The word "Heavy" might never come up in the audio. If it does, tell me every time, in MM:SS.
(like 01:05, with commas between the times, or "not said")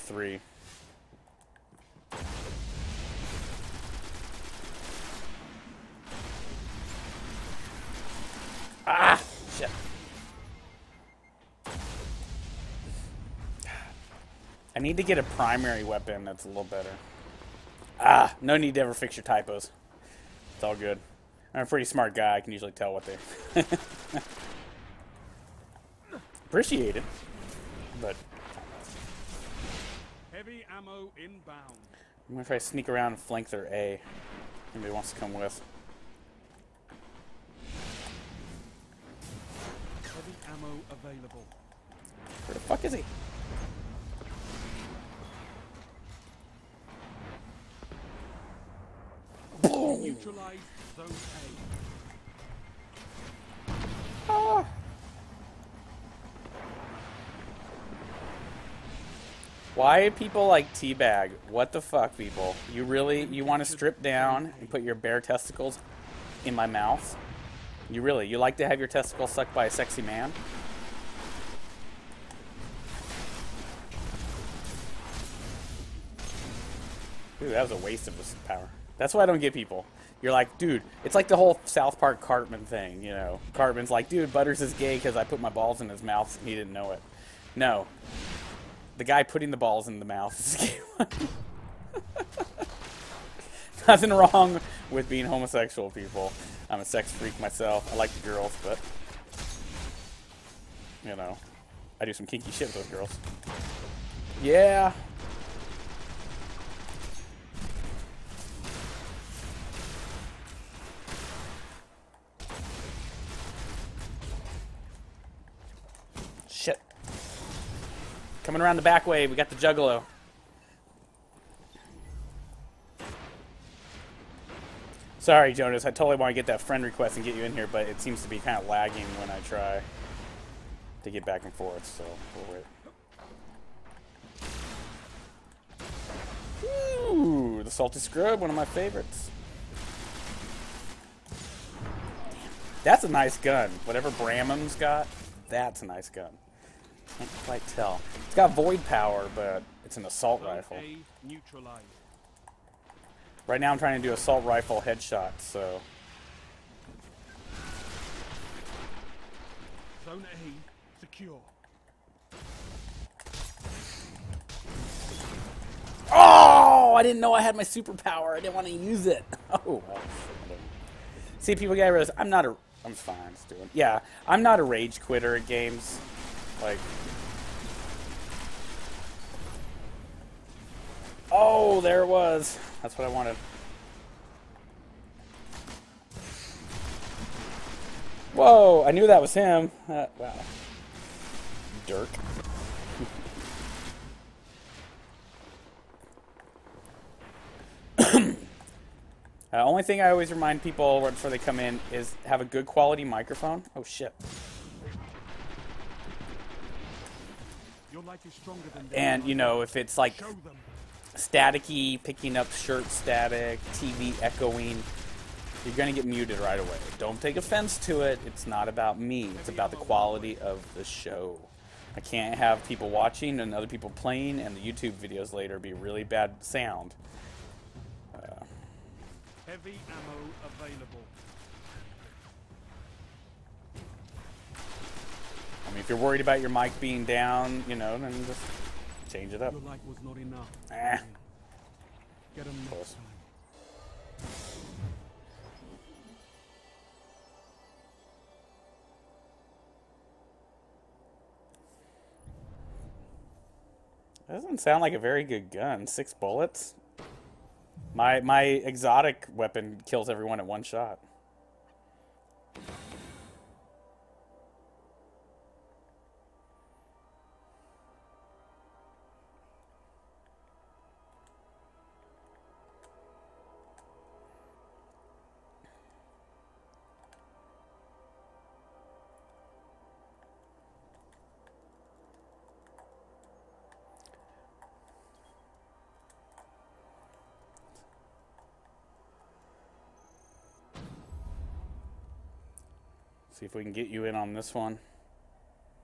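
00:30, 00:40, 03:49.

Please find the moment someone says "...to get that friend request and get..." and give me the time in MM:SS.
02:06.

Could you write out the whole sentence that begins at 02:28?
It's got void power, but it's an assault rifle.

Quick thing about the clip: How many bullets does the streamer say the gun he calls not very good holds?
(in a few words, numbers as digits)
6.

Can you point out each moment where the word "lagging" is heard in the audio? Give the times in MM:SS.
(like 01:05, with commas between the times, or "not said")
02:08.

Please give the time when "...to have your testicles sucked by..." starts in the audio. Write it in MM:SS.
01:08.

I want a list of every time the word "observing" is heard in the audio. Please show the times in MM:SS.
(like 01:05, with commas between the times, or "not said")
not said.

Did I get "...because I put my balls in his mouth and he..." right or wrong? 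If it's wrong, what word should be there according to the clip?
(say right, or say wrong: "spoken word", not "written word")
right.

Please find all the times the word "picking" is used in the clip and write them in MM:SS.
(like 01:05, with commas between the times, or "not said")
03:32.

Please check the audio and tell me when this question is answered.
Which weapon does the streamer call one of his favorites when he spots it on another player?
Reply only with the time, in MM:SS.
02:17.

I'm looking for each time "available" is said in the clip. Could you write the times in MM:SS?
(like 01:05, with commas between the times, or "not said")
00:40, 03:50.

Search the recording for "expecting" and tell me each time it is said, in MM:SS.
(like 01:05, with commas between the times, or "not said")
not said.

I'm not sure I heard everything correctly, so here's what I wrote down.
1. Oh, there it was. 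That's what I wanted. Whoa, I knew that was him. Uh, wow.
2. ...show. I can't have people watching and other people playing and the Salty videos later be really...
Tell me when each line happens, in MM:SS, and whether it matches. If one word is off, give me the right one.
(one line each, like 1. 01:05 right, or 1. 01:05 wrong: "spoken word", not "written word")
1. 03:01 right
2. 03:40 wrong: "YouTube", not "Salty".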